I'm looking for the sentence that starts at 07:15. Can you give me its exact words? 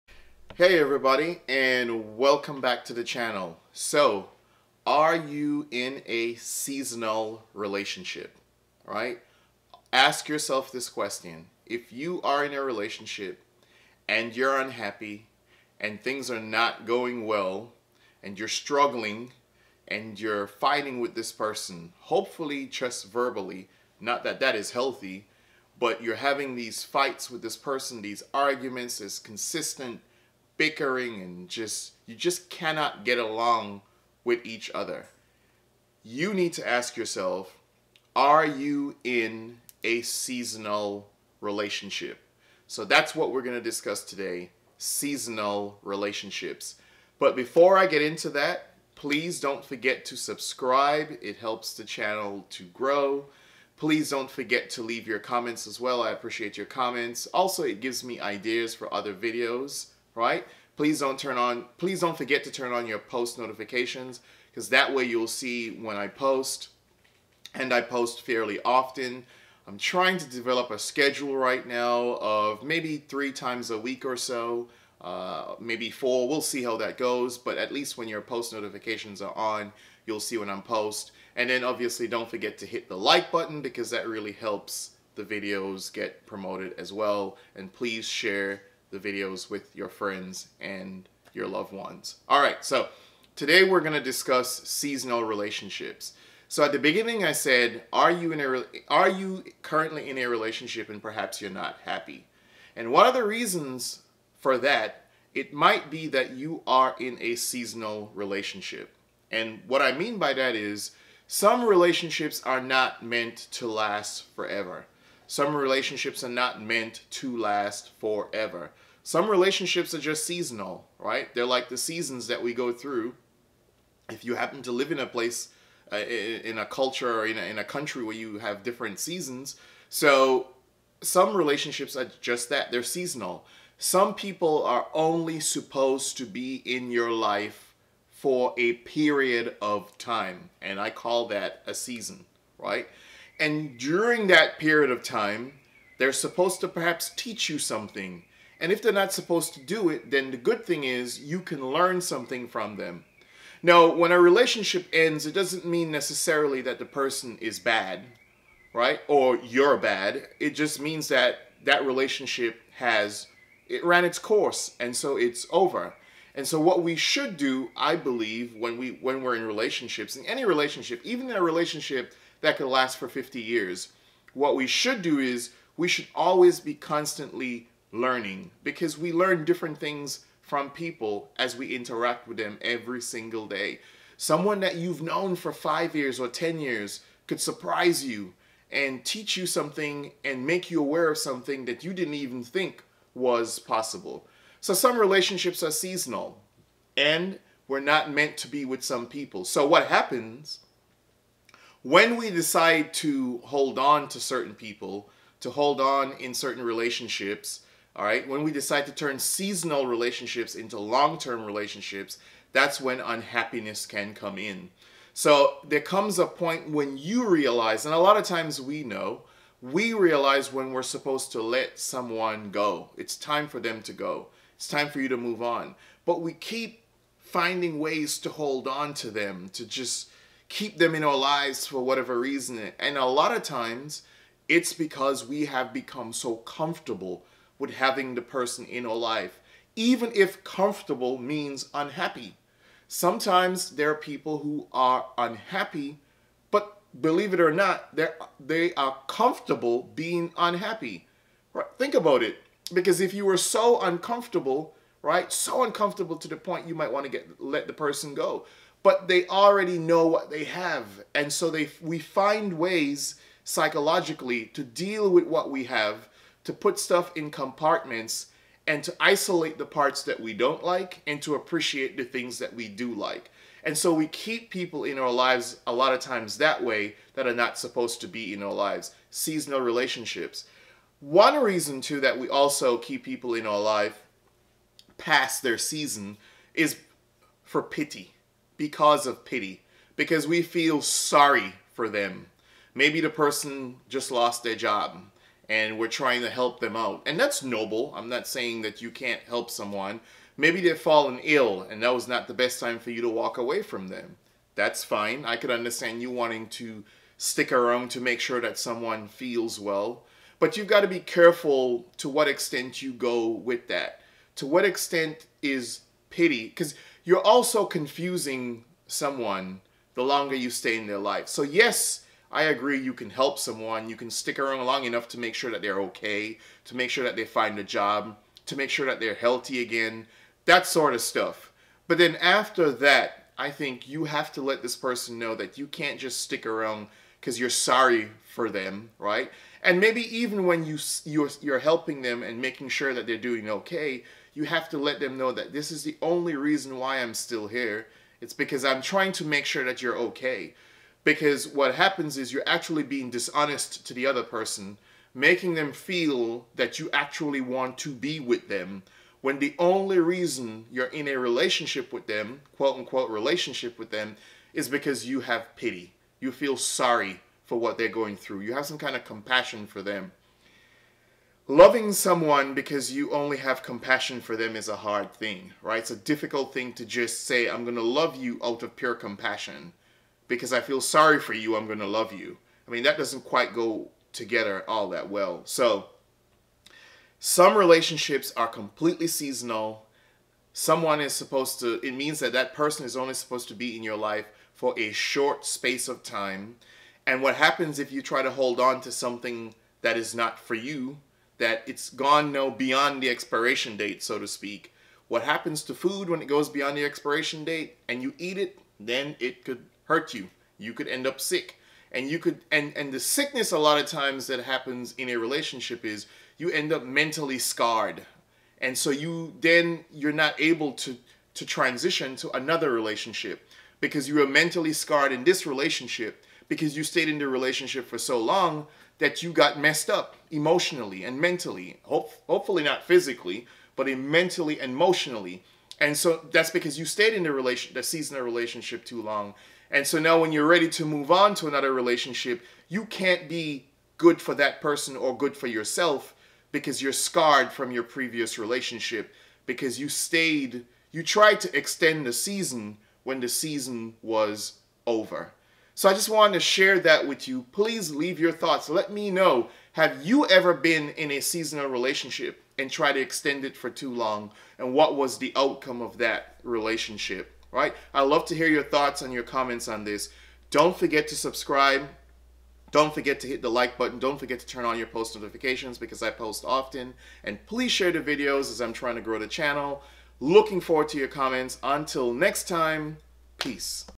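And so that's because you stayed in the relation the season of relationship too long.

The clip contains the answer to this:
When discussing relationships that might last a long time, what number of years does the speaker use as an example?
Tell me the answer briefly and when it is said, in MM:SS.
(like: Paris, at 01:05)
50, at 02:53.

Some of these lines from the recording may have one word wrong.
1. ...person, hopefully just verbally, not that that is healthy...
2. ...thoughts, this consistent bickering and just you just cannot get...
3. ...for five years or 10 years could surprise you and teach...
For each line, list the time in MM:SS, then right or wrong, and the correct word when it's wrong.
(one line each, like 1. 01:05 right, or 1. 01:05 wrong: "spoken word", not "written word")
1. 00:21 right
2. 00:28 wrong: "arguments", not "thoughts"
3. 03:05 right.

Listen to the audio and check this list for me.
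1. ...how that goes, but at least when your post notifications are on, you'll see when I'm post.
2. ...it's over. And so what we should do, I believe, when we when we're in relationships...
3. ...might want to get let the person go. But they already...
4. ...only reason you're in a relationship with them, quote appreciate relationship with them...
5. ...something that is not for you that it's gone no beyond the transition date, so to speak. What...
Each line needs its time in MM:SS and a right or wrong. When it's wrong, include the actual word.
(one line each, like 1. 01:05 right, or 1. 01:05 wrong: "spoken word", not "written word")
1. 01:16 right
2. 02:45 right
3. 04:16 right
4. 05:59 wrong: "unquote", not "appreciate"
5. 06:38 wrong: "expiration", not "transition".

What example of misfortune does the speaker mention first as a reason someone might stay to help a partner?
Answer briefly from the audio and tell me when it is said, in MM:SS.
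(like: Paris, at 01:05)
lost their job, at 04:54.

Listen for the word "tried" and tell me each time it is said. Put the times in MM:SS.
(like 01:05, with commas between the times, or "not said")
07:31, 07:42.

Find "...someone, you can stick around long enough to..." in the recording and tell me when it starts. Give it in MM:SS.
05:23.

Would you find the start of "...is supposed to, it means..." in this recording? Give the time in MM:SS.
06:31.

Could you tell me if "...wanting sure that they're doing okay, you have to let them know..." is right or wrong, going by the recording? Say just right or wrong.
wrong.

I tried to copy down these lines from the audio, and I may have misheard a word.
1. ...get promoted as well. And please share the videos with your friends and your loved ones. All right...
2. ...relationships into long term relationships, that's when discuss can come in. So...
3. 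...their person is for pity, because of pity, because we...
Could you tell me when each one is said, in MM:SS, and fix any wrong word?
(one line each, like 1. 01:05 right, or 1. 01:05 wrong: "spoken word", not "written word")
1. 01:25 right
2. 03:29 wrong: "unhappiness", not "discuss"
3. 04:45 wrong: "season", not "person".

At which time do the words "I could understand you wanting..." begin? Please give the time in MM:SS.
05:05.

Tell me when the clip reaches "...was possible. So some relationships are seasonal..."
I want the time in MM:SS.
03:13.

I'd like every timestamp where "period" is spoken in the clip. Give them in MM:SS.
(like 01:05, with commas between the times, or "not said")
02:18, 02:24.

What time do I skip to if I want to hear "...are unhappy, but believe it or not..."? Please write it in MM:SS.
04:04.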